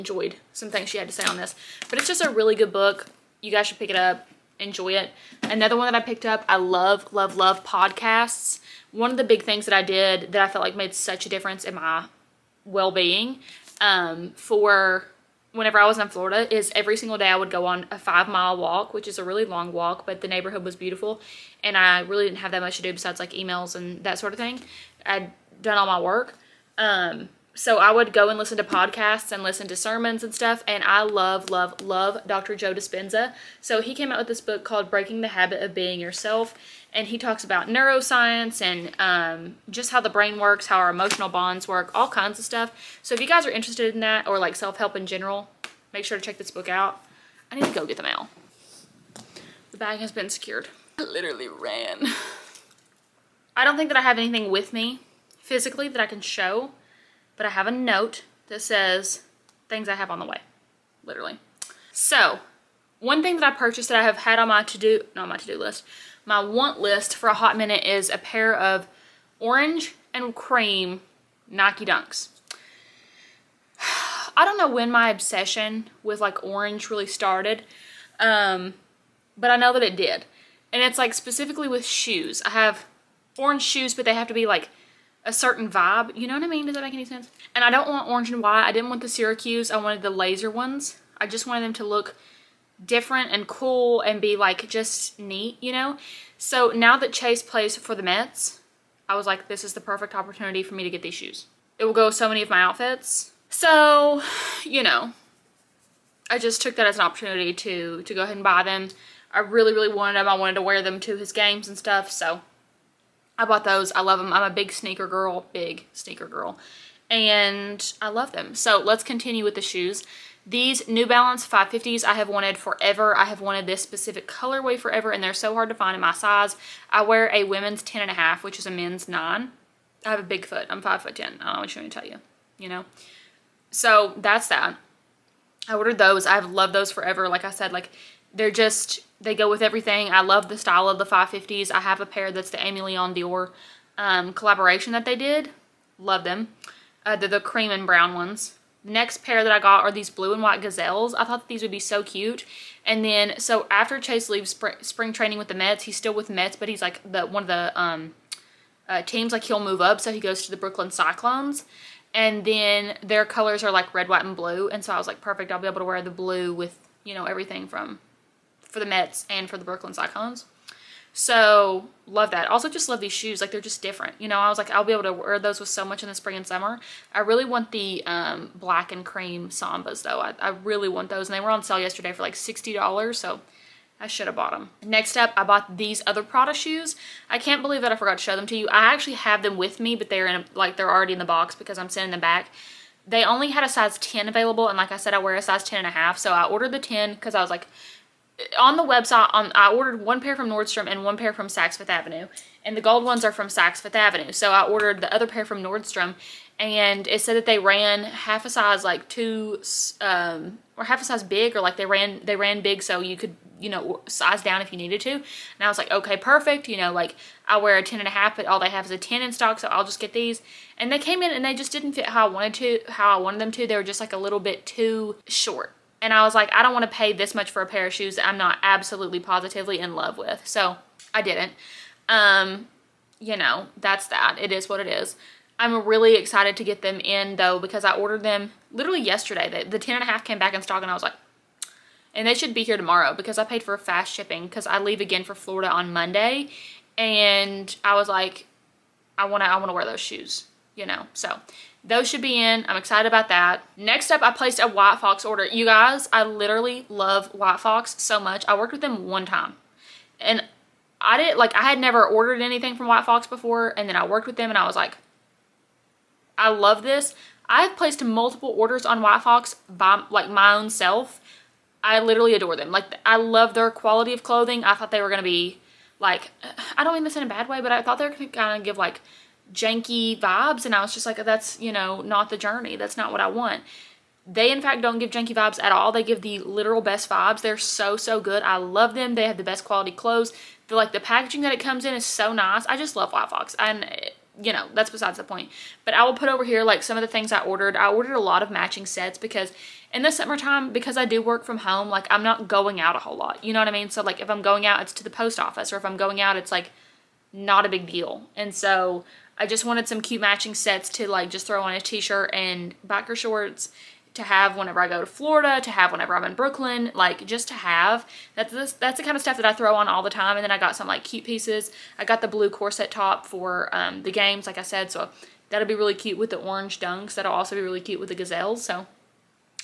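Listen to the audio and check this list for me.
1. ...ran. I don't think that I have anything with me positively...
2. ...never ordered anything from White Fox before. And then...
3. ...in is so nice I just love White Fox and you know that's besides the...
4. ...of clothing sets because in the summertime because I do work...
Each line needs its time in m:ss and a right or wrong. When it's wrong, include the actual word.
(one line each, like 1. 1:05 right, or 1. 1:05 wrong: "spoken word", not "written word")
1. 0:51 wrong: "physically", not "positively"
2. 4:21 right
3. 4:51 right
4. 4:58 wrong: "matching", not "clothing".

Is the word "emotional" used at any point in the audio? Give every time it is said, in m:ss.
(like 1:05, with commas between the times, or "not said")
0:40.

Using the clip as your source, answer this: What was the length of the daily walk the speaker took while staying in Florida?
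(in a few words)
5 miles.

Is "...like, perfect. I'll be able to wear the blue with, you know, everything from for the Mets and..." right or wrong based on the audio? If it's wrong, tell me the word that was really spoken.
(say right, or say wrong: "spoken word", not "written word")
right.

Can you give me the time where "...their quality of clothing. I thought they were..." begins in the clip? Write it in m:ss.
4:33.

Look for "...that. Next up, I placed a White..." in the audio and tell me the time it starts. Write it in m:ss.
4:13.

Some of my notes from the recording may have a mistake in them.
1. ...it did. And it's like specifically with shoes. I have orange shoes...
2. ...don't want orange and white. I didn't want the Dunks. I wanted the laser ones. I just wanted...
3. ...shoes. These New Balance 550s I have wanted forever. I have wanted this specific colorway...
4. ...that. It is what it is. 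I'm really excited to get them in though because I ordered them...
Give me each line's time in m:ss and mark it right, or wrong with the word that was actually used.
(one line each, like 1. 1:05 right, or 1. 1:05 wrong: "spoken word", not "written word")
1. 1:19 right
2. 1:27 wrong: "Syracuse", not "Dunks"
3. 1:59 right
4. 3:54 right.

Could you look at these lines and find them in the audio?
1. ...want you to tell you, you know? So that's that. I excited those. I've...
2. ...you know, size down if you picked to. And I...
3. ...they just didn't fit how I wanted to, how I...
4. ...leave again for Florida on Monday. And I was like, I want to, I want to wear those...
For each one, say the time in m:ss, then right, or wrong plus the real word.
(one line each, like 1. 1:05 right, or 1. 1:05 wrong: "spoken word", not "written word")
1. 2:11 wrong: "ordered", not "excited"
2. 3:33 wrong: "needed", not "picked"
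3. 3:41 right
4. 4:04 right.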